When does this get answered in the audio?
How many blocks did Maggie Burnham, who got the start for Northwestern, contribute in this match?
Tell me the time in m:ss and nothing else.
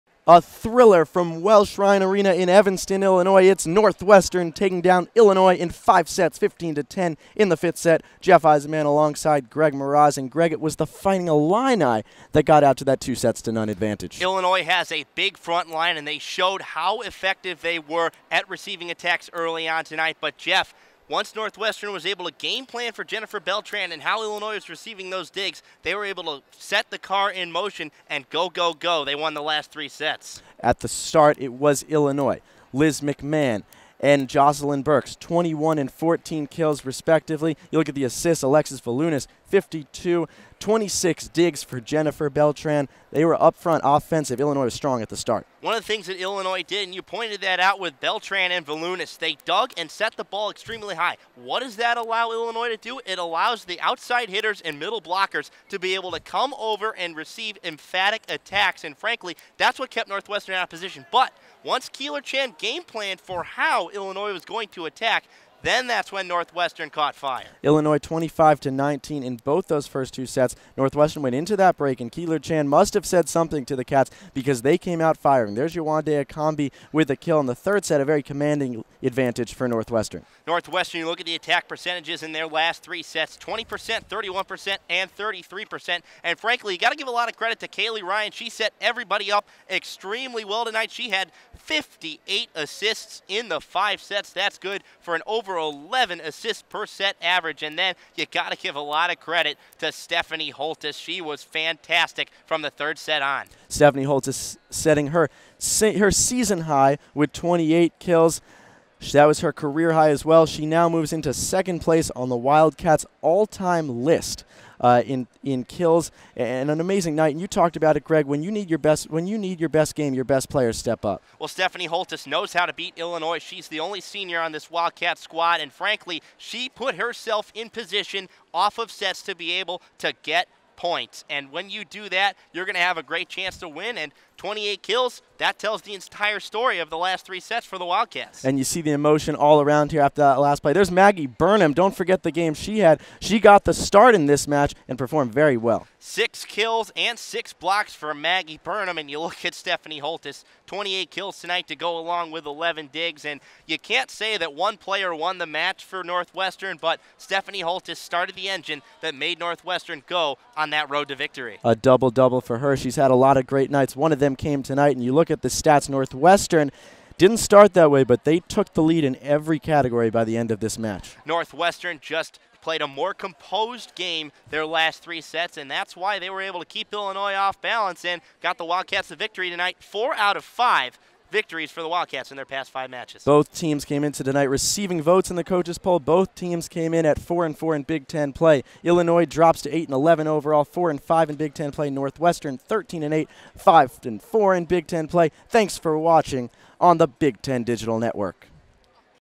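2:27.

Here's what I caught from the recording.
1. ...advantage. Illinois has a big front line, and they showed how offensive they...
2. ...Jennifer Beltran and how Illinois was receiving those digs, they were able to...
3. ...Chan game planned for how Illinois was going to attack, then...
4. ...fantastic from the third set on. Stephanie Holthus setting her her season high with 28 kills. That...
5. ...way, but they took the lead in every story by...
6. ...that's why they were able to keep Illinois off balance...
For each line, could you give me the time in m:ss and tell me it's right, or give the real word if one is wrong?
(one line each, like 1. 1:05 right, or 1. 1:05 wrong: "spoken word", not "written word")
1. 0:13 wrong: "effective", not "offensive"
2. 0:23 right
3. 1:02 right
4. 1:41 right
5. 2:47 wrong: "category", not "story"
6. 2:55 right.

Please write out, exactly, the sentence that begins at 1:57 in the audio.
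And you talked about it, Greg.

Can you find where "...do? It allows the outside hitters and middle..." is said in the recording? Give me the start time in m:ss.
0:52.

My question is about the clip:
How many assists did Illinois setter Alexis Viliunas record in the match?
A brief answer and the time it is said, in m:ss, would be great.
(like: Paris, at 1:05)
52, at 0:39.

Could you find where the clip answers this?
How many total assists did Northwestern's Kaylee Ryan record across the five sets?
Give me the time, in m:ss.
1:31.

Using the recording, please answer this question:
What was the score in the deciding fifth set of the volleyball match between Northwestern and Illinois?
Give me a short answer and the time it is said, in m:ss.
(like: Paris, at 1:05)
15 to 10, at 0:06.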